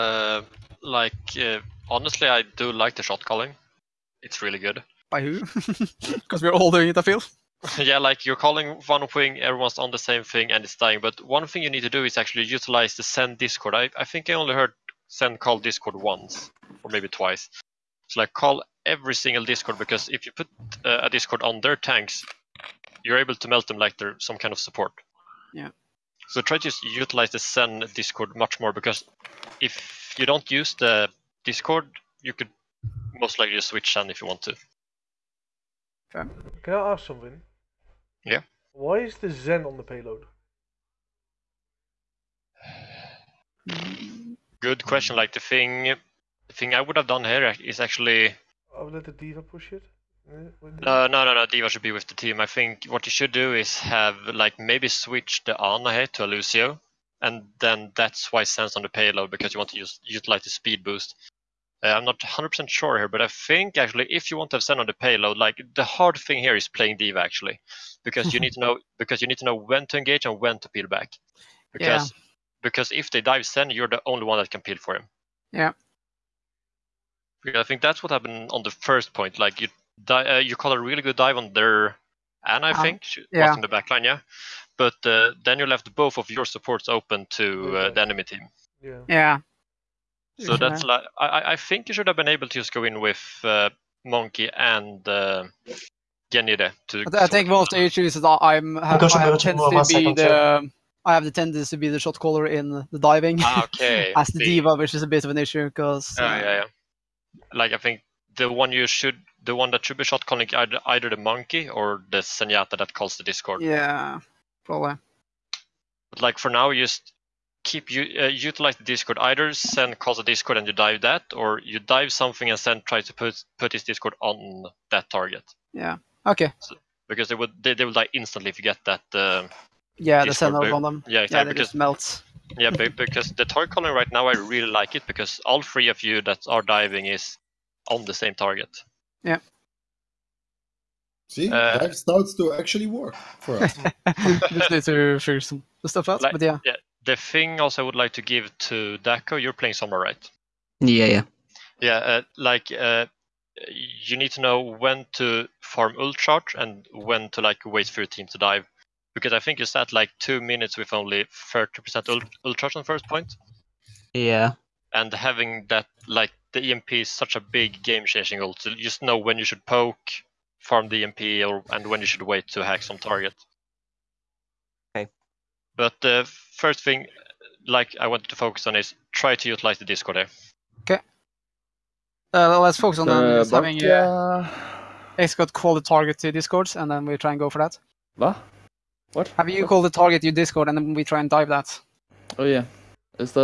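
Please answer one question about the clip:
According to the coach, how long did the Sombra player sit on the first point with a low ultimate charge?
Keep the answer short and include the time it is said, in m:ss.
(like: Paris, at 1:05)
2 minutes, at 2:40.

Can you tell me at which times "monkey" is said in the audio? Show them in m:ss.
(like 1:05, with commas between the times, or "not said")
1:34, 1:51.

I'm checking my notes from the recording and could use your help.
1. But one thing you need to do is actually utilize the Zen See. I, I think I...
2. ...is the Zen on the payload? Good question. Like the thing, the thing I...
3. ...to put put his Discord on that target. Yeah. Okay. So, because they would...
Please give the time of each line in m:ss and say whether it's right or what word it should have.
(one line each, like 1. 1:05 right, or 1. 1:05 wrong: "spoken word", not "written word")
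1. 0:10 wrong: "Discord", not "See"
2. 0:38 right
3. 2:02 right.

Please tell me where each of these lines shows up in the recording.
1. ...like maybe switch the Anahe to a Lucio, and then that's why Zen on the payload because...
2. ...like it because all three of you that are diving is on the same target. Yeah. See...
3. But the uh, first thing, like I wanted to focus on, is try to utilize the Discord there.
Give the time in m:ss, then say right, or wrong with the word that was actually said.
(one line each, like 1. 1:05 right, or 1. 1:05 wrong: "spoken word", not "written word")
1. 0:54 right
2. 2:14 right
3. 2:55 right.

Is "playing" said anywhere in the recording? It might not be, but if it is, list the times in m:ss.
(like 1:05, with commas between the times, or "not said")
1:06, 2:29.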